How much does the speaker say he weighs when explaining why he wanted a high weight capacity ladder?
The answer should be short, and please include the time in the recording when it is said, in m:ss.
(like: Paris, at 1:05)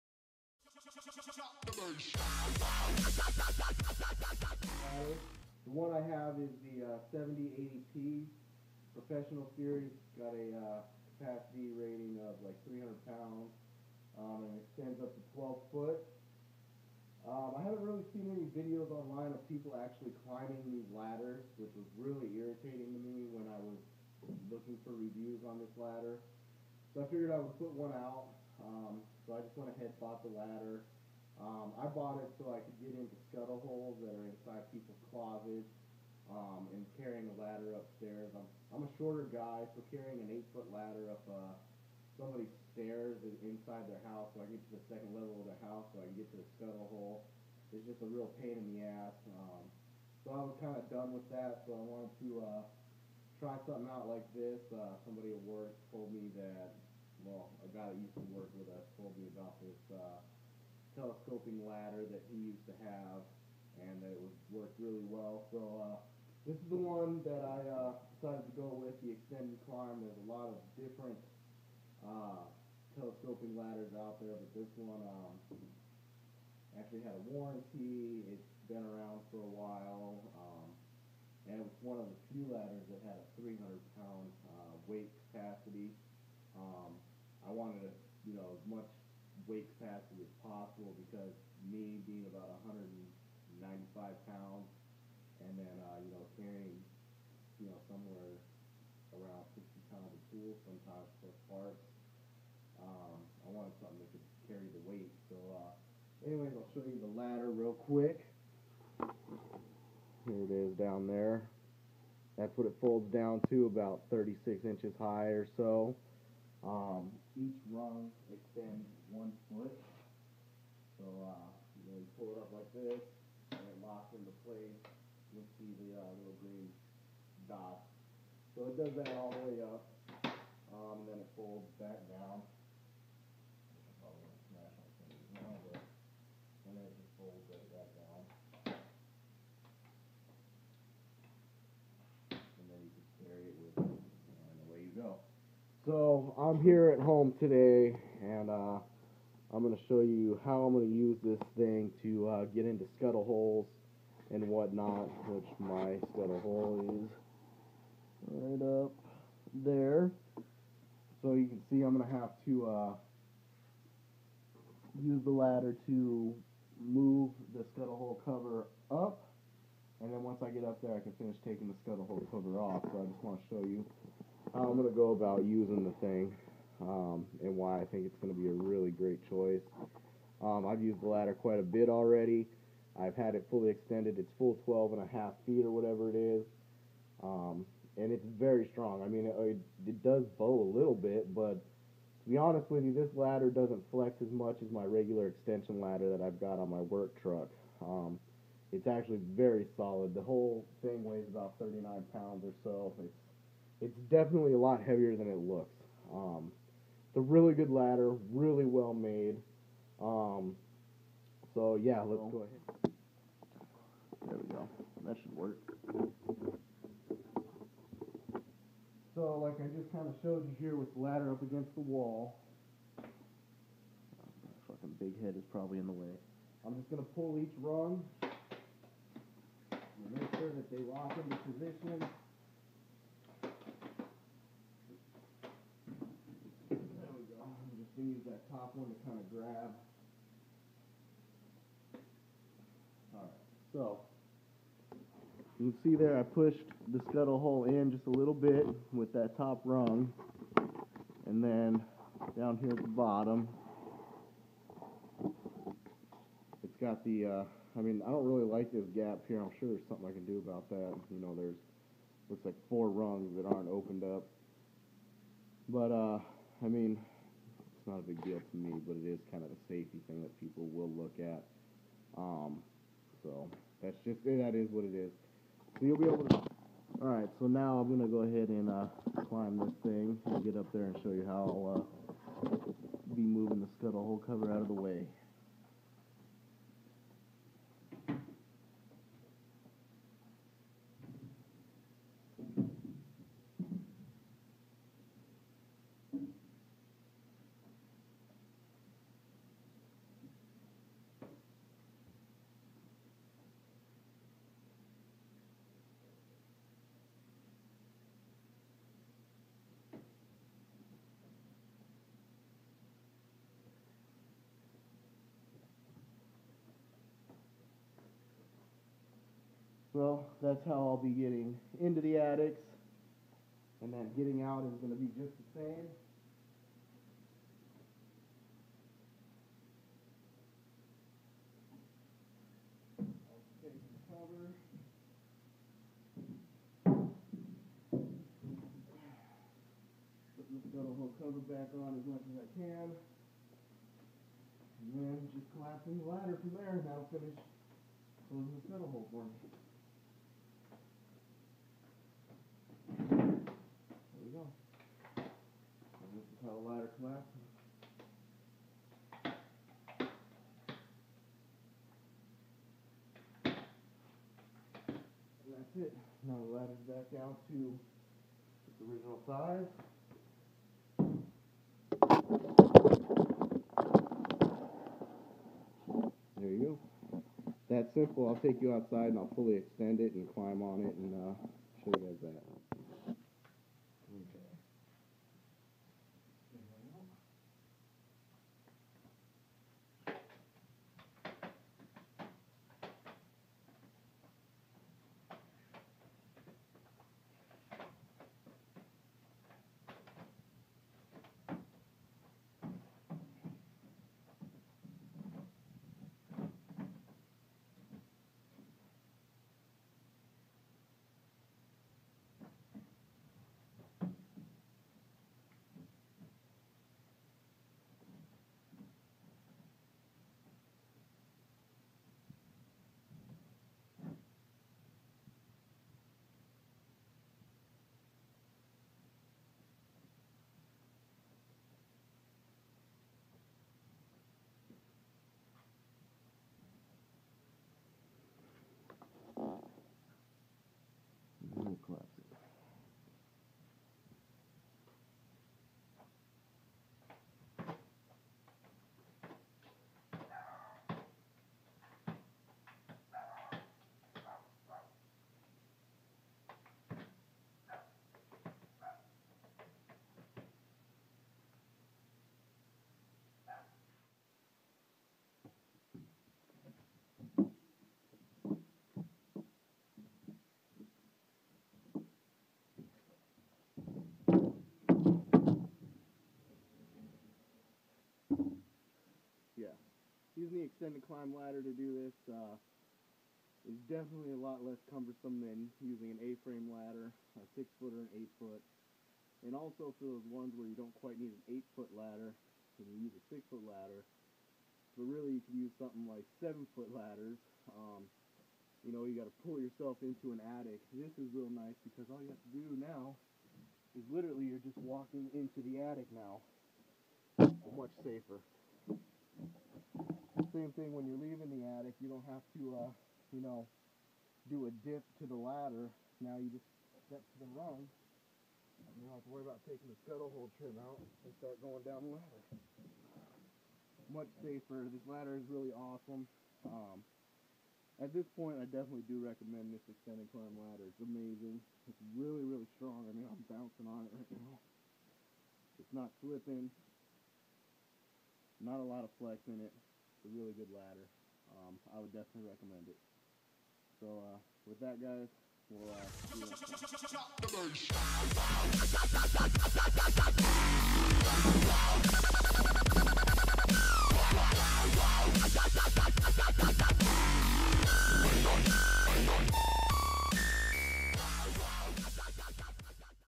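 195 pounds, at 1:32.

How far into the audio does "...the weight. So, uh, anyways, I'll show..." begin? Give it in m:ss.
1:44.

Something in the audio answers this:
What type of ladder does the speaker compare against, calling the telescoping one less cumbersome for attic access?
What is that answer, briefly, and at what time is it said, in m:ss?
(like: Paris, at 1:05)
A-frame ladder, at 8:06.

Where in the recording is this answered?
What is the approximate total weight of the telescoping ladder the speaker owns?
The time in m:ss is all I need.
3:21.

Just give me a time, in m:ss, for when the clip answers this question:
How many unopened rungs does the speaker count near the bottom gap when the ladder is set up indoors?
4:22.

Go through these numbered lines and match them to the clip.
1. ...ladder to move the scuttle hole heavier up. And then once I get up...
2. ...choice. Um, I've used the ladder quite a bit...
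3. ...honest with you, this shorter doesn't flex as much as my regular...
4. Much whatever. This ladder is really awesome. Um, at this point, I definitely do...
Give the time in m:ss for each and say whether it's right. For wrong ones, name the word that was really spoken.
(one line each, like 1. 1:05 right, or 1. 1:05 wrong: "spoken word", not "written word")
1. 2:45 wrong: "cover", not "heavier"
2. 2:59 right
3. 3:12 wrong: "ladder", not "shorter"
4. 8:44 wrong: "safer", not "whatever".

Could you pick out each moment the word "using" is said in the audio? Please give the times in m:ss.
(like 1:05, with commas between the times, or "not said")
2:55, 8:00, 8:05.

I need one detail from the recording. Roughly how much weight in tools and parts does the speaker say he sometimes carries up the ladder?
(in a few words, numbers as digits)
60 pounds.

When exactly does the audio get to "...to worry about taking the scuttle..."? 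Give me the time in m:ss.
8:39.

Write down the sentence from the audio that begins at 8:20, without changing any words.
This is real nice because all you have to do now is literally you're just walking into the attic now.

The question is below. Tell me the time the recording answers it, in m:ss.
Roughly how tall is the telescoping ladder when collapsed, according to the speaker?
1:54.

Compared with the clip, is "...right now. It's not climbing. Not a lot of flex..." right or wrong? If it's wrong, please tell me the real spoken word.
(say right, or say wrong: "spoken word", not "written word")
wrong: "slipping", not "climbing".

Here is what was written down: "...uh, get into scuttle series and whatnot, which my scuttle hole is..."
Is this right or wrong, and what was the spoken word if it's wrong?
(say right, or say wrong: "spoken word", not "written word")
wrong: "holes", not "series".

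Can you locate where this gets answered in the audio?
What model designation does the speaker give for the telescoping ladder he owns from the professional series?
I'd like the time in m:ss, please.
0:07.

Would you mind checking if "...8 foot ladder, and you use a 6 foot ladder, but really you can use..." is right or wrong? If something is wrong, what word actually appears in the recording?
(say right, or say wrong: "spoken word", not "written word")
right.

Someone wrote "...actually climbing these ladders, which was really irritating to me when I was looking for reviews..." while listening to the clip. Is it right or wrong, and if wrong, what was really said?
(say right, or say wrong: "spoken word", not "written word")
right.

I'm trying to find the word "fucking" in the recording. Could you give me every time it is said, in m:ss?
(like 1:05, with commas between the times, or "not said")
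3:44.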